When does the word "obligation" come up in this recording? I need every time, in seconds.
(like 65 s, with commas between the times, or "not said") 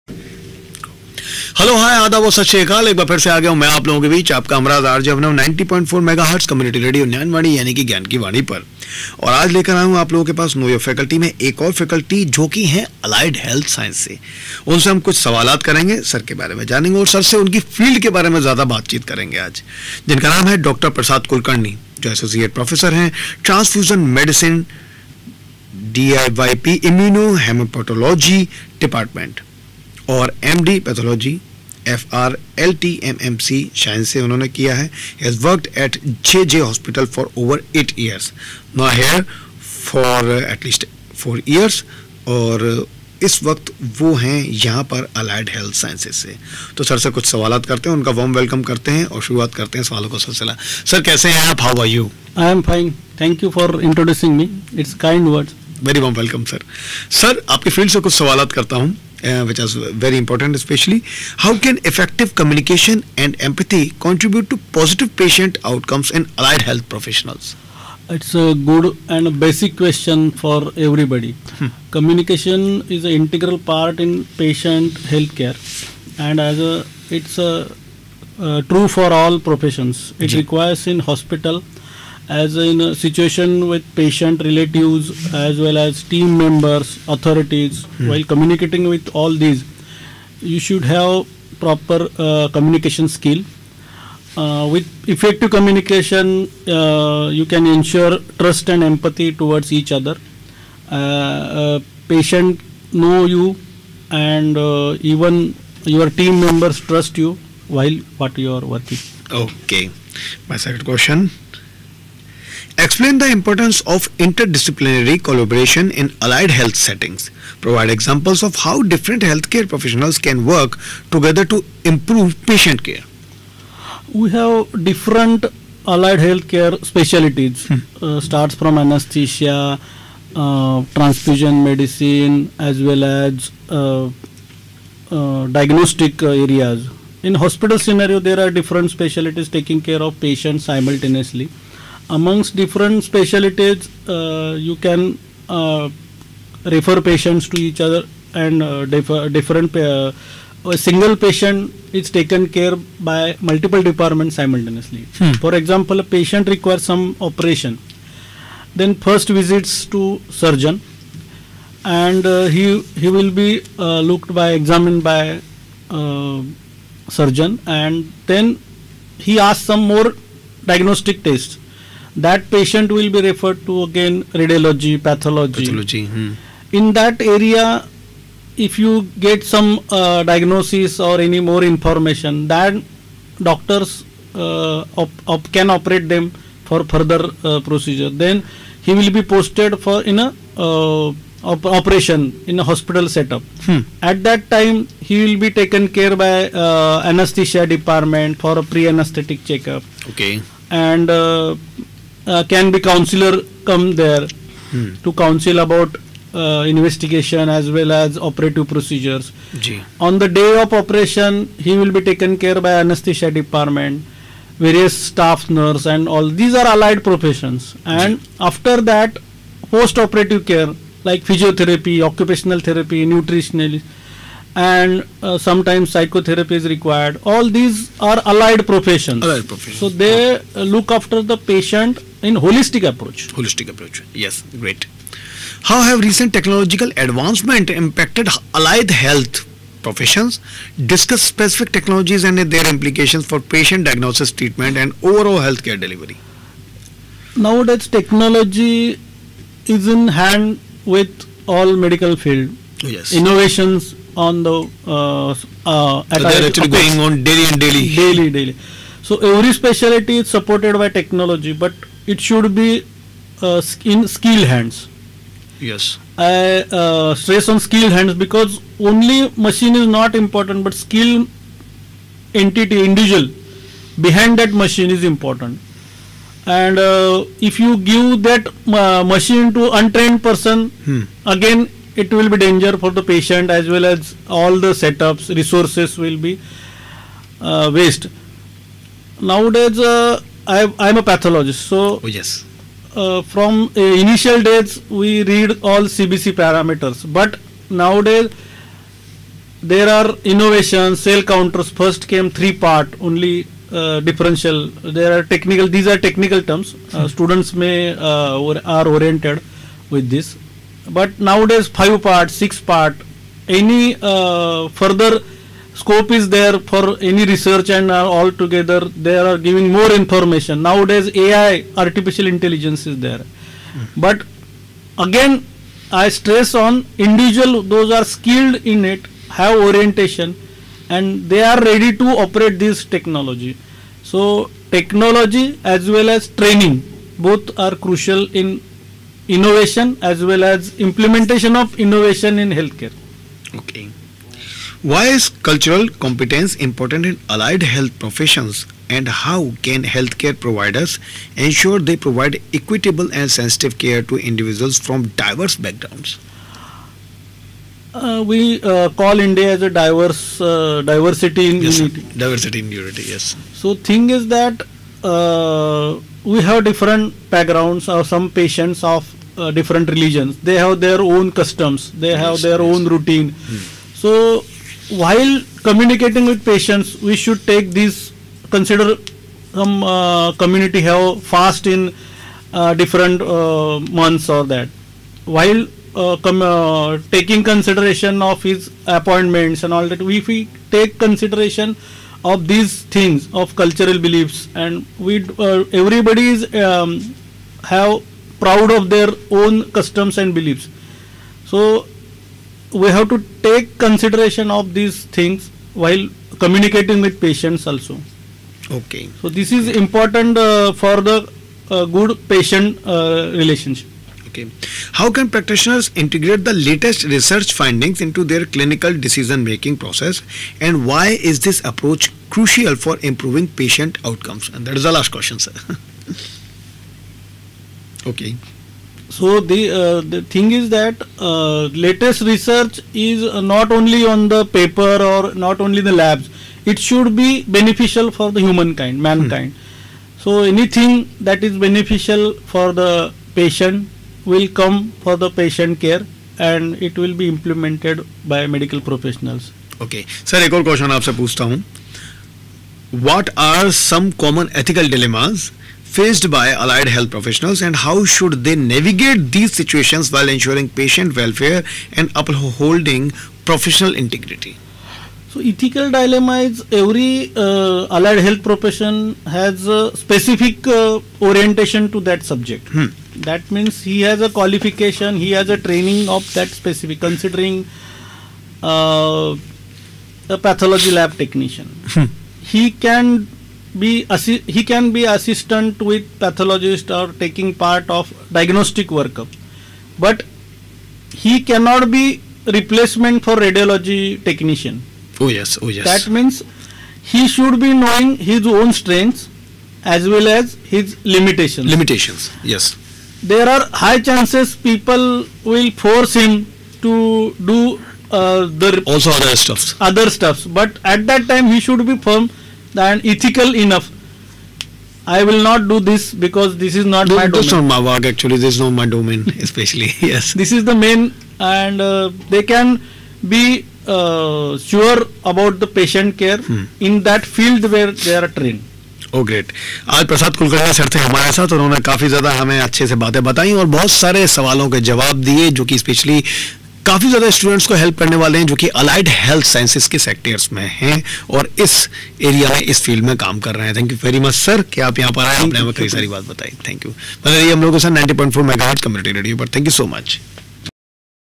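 not said.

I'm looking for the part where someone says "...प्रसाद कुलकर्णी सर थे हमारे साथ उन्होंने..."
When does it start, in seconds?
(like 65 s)
530 s.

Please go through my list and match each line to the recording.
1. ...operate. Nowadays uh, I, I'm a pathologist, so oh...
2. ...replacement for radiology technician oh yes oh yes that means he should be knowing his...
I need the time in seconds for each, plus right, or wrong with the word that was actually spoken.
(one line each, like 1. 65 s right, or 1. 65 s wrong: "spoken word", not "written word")
1. 287 s wrong: "waste", not "operate"
2. 492 s right.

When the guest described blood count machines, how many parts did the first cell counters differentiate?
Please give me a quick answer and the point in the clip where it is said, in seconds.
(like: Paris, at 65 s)
3, at 302 s.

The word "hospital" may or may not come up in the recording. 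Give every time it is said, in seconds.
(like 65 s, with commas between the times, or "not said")
80 s, 137 s, 192 s.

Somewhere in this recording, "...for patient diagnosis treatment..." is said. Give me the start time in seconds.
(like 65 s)
243 s.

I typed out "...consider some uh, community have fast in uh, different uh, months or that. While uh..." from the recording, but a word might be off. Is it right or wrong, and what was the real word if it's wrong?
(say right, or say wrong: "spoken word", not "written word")
right.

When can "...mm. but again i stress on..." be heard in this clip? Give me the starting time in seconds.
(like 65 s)
323 s.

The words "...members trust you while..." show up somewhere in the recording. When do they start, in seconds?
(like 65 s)
106 s.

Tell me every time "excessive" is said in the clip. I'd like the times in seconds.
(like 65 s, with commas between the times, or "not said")
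not said.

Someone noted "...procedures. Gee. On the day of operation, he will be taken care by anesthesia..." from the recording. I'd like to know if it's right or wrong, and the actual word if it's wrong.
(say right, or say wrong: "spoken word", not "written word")
right.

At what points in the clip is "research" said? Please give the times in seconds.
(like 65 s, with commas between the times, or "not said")
317 s, 417 s, 432 s.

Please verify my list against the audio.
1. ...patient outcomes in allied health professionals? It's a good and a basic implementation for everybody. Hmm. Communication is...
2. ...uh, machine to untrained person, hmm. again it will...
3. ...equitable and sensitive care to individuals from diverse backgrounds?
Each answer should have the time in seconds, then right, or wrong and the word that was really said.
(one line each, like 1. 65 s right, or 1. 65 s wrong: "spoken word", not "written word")
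1. 65 s wrong: "question", not "implementation"
2. 278 s right
3. 352 s right.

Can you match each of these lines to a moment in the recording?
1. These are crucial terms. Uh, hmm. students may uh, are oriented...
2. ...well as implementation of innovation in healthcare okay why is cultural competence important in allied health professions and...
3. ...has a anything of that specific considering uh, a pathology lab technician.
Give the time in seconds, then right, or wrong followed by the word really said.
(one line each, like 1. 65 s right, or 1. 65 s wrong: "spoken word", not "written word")
1. 305 s wrong: "technical", not "crucial"
2. 340 s right
3. 475 s wrong: "training", not "anything".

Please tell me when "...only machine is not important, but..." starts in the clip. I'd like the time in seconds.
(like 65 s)
268 s.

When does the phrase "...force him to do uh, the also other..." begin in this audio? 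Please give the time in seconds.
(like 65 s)
505 s.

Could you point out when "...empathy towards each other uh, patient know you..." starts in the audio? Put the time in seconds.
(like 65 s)
98 s.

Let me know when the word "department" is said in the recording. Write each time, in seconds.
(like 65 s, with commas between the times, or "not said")
153 s, 197 s, 213 s.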